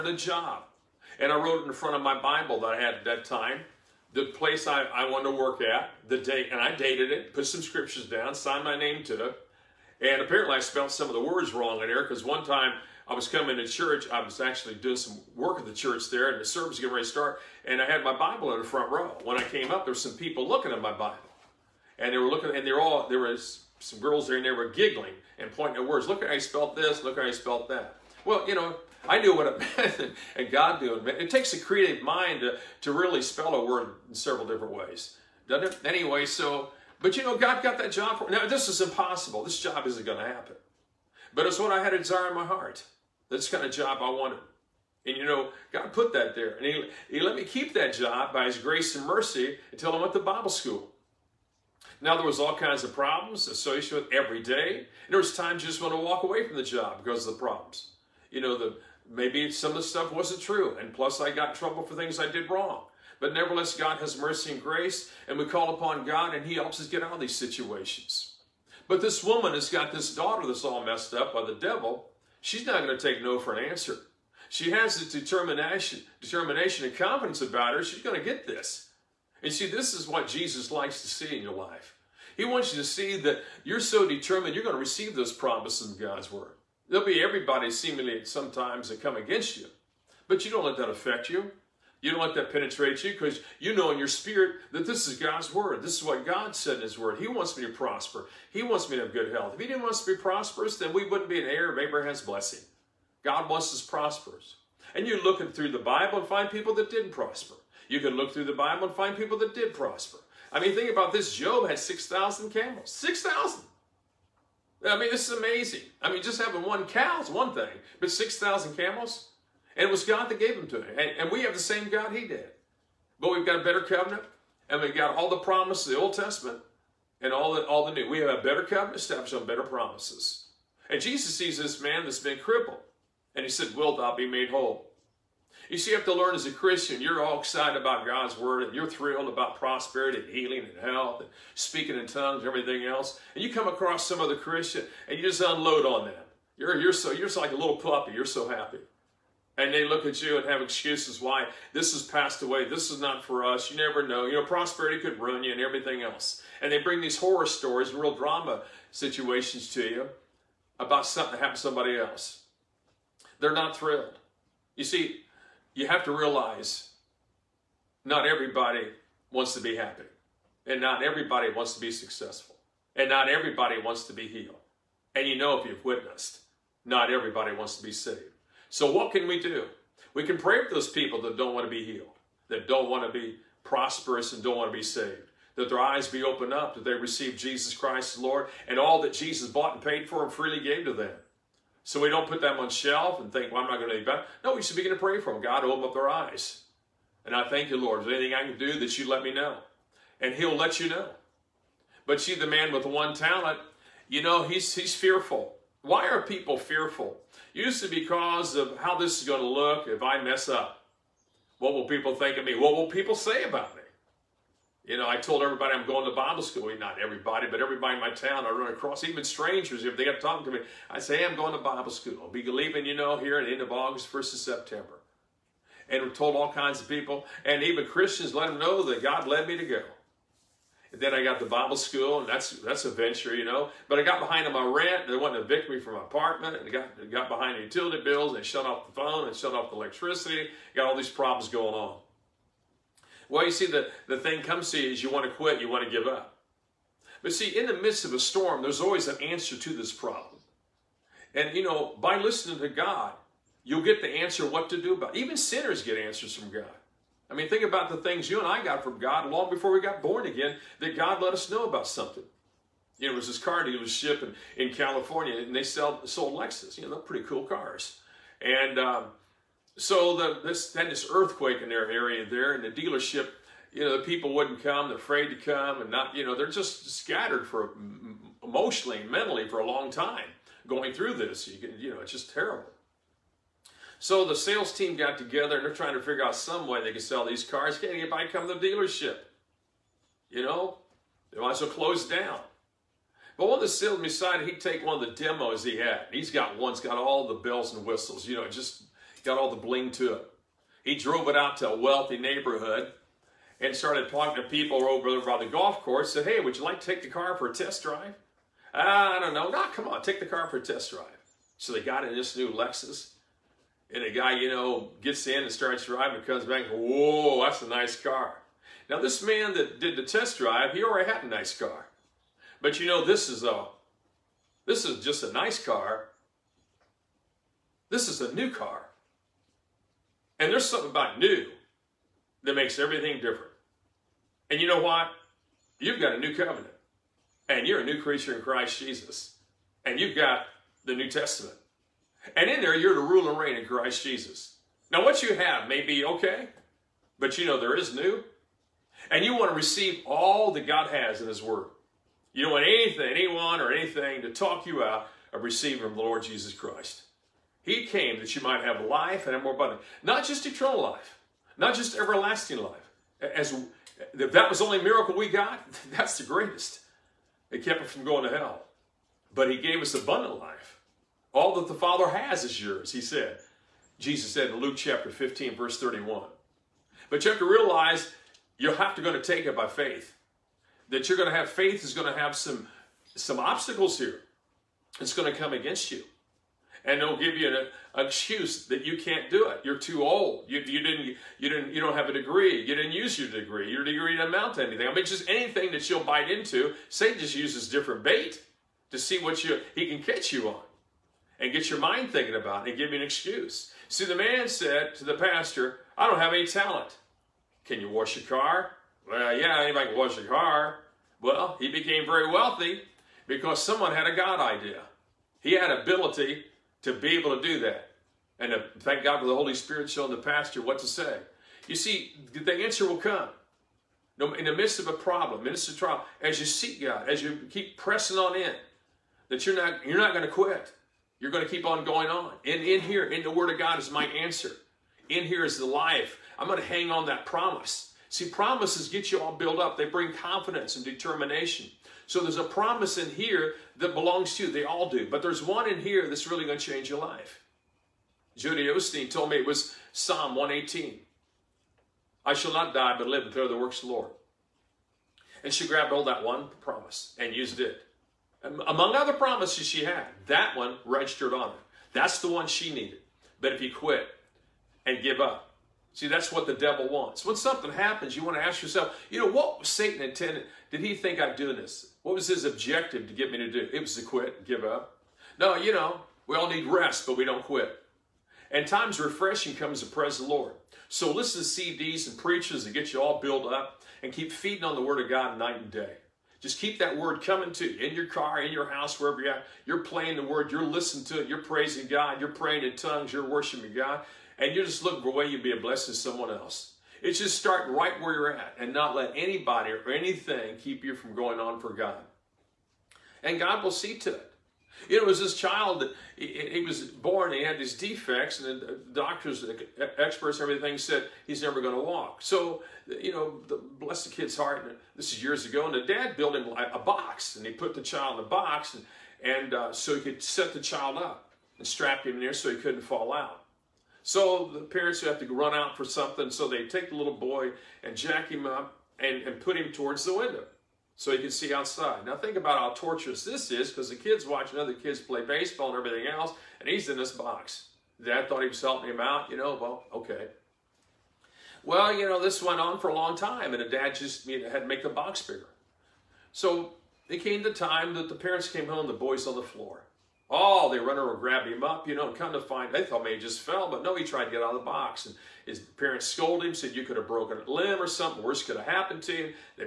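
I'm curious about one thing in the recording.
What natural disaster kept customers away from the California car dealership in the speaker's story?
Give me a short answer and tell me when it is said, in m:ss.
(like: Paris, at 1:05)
Earthquake, at 4:31.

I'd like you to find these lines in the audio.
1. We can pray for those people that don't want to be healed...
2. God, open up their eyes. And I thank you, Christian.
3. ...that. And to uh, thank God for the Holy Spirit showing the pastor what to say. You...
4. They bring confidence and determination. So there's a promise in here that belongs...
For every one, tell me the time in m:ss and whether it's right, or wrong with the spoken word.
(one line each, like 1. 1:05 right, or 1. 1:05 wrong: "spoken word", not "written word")
1. 3:00 right
2. 3:15 wrong: "Lord", not "Christian"
3. 6:57 right
4. 7:19 right.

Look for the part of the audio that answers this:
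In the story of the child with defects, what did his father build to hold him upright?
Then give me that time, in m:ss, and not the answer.
8:36.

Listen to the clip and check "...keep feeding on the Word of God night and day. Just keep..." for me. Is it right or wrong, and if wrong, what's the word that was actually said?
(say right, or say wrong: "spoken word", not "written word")
right.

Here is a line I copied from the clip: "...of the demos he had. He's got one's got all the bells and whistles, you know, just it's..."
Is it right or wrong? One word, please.
right.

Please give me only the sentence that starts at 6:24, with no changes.
It's going to come against you and they'll give you an, an excuse that you can't do it.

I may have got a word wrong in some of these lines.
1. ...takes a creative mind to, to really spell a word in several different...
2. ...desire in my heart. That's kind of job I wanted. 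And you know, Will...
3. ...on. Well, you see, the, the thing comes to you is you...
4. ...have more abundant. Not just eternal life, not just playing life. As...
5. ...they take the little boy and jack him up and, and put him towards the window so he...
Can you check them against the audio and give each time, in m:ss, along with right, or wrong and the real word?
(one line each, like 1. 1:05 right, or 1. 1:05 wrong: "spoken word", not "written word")
1. 0:31 right
2. 0:41 wrong: "God", not "Will"
3. 4:01 right
4. 5:59 wrong: "everlasting", not "playing"
5. 8:46 right.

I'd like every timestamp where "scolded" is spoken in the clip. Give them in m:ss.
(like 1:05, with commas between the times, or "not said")
9:16.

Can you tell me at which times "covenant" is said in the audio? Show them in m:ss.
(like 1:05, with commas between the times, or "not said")
2:03, 2:08, 5:36.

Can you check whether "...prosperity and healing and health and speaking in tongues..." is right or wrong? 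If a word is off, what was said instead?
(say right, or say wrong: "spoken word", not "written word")
right.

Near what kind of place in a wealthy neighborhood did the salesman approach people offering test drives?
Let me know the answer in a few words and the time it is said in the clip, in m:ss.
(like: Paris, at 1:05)
Golf course, at 5:05.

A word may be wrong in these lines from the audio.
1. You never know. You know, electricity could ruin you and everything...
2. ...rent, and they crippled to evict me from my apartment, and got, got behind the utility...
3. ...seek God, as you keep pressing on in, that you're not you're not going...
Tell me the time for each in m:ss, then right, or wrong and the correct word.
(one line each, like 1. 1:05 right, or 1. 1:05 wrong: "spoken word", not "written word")
1. 2:33 wrong: "prosperity", not "electricity"
2. 3:54 wrong: "wanted", not "crippled"
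3. 7:06 right.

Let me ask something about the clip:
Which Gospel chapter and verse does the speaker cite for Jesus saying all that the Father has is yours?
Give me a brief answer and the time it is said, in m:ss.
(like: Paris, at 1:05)
Luke 15:31, at 6:14.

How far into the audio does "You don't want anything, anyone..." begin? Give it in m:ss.
5:52.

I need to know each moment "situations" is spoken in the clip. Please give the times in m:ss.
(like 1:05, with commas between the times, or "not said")
1:07, 2:38.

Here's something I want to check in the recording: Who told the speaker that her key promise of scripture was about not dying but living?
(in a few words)
Dodie Osteen.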